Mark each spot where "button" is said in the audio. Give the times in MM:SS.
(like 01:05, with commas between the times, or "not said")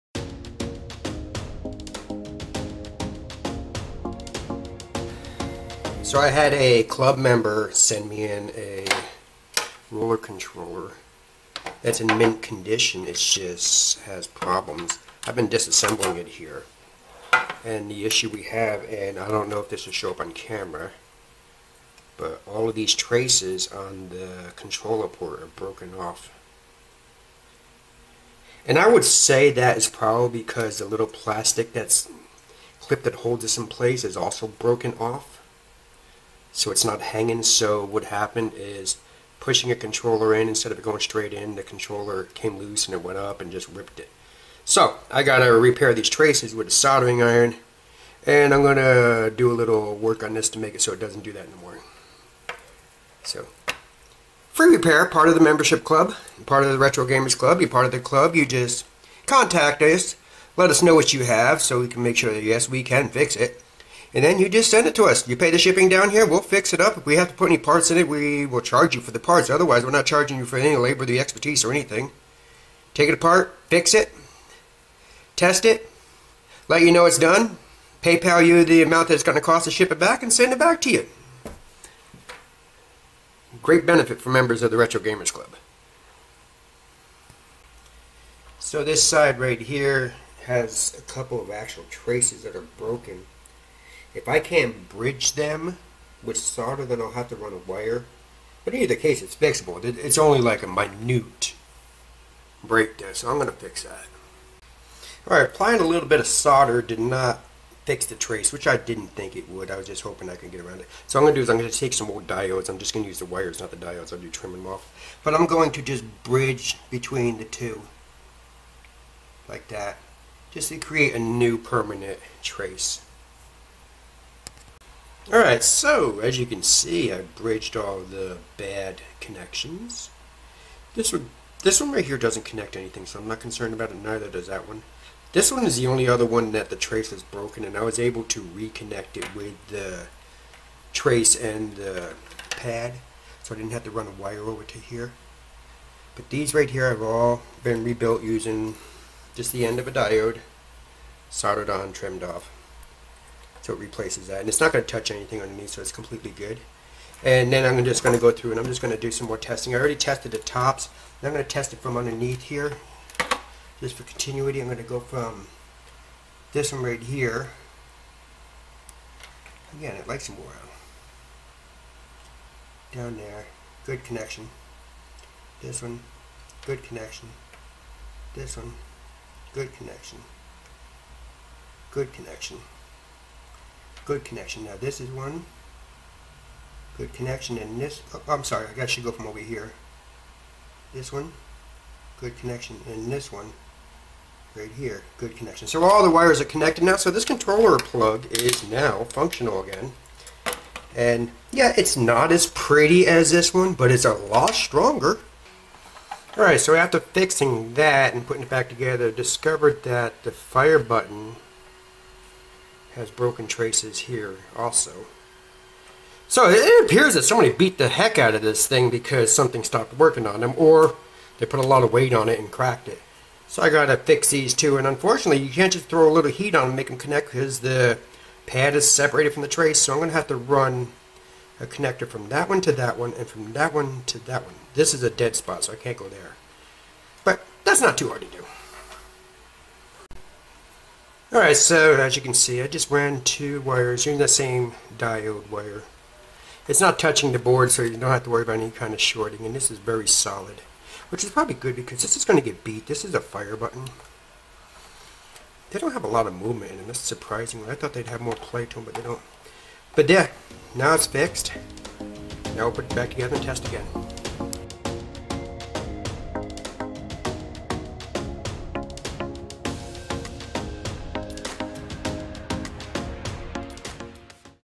03:30, 04:13.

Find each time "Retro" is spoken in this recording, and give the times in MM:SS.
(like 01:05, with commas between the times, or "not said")
00:56, 01:24.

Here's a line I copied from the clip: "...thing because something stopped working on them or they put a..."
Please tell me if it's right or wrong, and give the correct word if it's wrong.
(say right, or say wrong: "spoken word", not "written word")
right.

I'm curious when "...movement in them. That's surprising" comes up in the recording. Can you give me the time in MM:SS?
04:16.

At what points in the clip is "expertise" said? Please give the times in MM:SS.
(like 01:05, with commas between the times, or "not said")
01:11.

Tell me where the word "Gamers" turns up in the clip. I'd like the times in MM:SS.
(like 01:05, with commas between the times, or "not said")
00:57, 01:24.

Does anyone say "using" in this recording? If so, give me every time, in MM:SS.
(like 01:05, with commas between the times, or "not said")
02:28, 04:04.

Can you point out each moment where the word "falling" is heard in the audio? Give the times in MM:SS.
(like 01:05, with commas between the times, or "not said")
not said.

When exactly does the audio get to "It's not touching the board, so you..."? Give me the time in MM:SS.
04:06.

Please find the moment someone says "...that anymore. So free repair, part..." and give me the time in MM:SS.
00:51.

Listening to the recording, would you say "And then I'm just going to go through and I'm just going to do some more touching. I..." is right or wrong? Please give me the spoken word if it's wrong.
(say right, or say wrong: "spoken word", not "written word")
wrong: "testing", not "touching".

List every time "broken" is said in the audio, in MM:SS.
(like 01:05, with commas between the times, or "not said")
00:25, 00:34, 01:32, 02:17, 03:33.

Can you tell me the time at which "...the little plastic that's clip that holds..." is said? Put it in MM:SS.
00:30.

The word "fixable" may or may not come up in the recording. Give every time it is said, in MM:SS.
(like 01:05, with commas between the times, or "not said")
01:39.